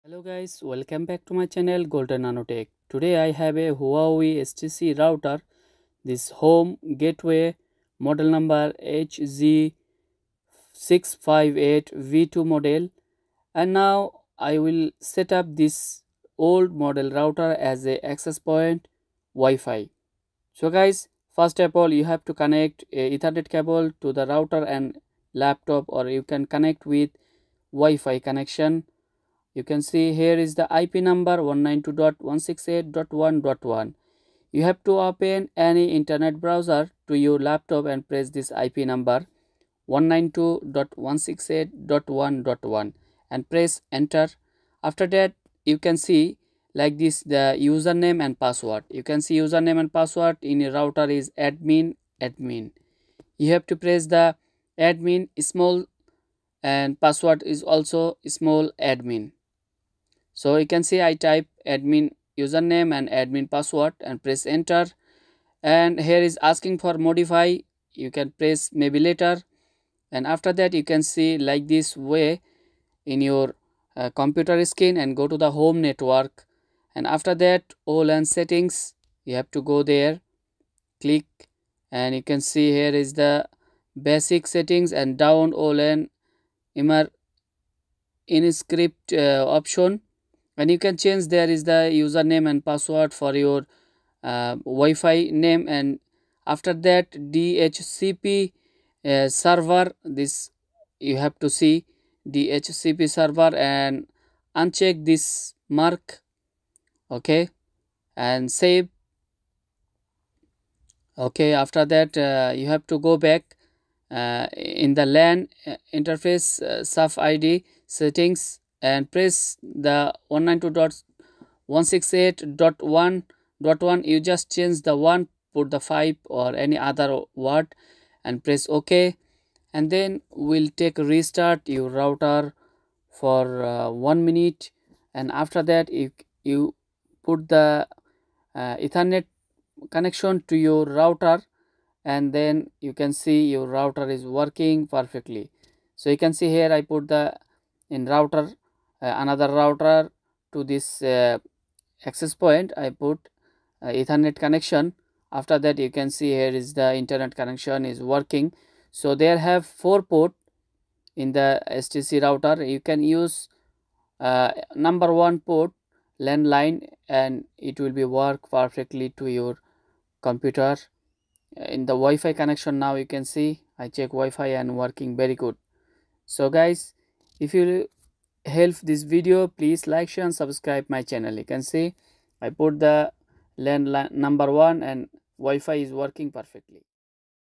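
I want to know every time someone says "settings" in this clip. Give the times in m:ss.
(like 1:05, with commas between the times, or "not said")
1:18, 1:24, 1:57.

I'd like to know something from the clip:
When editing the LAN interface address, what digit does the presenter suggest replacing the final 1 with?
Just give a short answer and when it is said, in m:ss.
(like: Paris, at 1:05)
5, at 2:05.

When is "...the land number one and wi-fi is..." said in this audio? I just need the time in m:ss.
3:02.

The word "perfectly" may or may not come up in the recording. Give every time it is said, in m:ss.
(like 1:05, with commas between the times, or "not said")
2:24, 2:48, 3:06.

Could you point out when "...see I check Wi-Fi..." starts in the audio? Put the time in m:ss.
2:53.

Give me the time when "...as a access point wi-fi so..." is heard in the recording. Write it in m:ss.
0:17.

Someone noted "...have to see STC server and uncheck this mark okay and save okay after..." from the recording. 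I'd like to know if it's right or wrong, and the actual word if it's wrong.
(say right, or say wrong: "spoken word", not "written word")
wrong: "DHCP", not "STC".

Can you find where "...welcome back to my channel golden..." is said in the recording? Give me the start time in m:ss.
0:00.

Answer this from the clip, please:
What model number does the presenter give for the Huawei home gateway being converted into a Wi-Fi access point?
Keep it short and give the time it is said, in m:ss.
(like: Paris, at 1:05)
HG658V2, at 0:08.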